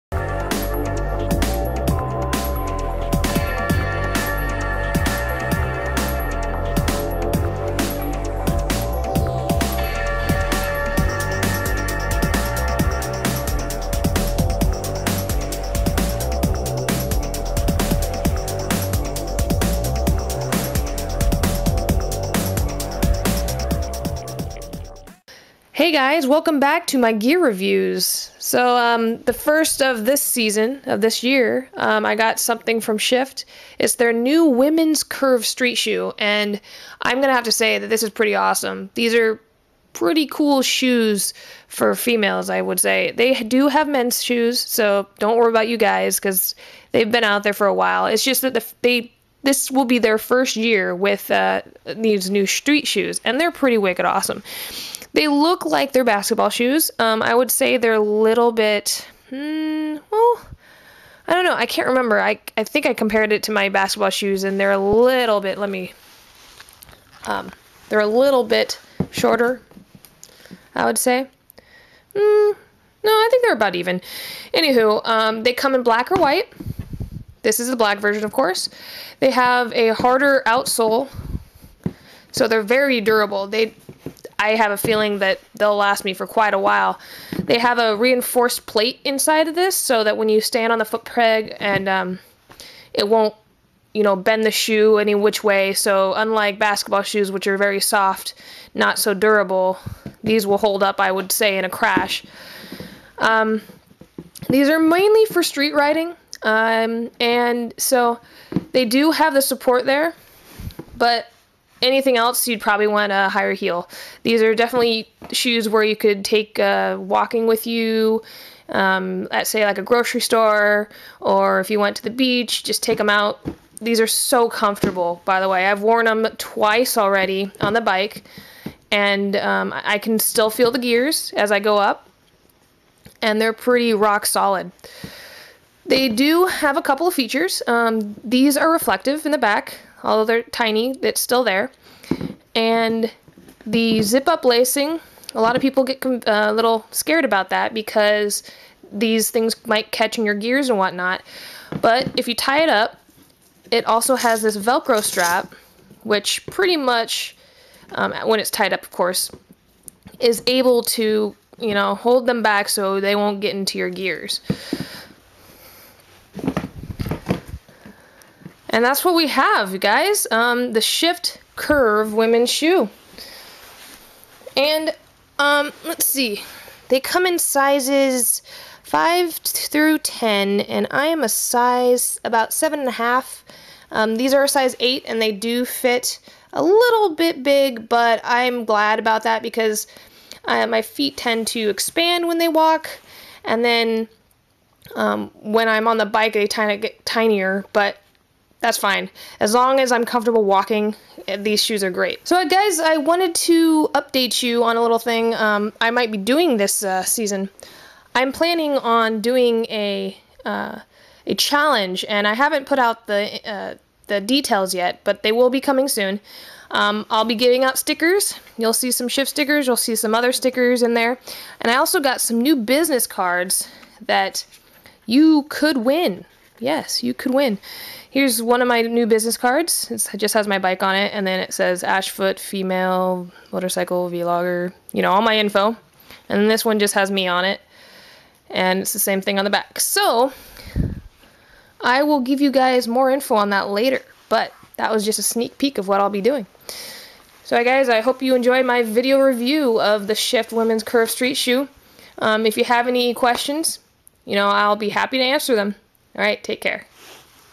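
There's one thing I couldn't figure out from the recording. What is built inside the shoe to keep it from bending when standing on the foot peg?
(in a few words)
reinforced plate.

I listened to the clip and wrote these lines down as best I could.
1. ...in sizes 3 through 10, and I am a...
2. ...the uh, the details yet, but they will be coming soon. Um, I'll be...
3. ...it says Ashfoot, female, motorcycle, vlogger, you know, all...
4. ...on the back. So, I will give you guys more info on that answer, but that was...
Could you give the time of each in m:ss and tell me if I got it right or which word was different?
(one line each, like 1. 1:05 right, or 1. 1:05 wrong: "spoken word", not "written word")
1. 2:57 wrong: "5", not "3"
2. 3:33 right
3. 3:51 right
4. 3:59 wrong: "later", not "answer".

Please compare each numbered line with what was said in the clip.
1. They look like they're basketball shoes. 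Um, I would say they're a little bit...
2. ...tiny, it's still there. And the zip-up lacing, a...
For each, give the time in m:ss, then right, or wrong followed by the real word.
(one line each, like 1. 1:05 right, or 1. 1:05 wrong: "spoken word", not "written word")
1. 0:55 right
2. 2:20 right.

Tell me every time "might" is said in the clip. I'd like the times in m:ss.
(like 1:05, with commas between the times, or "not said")
2:29, 3:25.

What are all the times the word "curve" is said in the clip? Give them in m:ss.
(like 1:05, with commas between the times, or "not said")
0:35, 2:51, 4:10.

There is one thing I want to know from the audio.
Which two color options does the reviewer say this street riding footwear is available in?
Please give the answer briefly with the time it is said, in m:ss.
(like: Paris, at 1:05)
black or white, at 1:15.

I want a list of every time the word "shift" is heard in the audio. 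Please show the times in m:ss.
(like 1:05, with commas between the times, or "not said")
0:32, 2:50, 3:39, 4:10.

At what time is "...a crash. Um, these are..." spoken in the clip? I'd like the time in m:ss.
1:41.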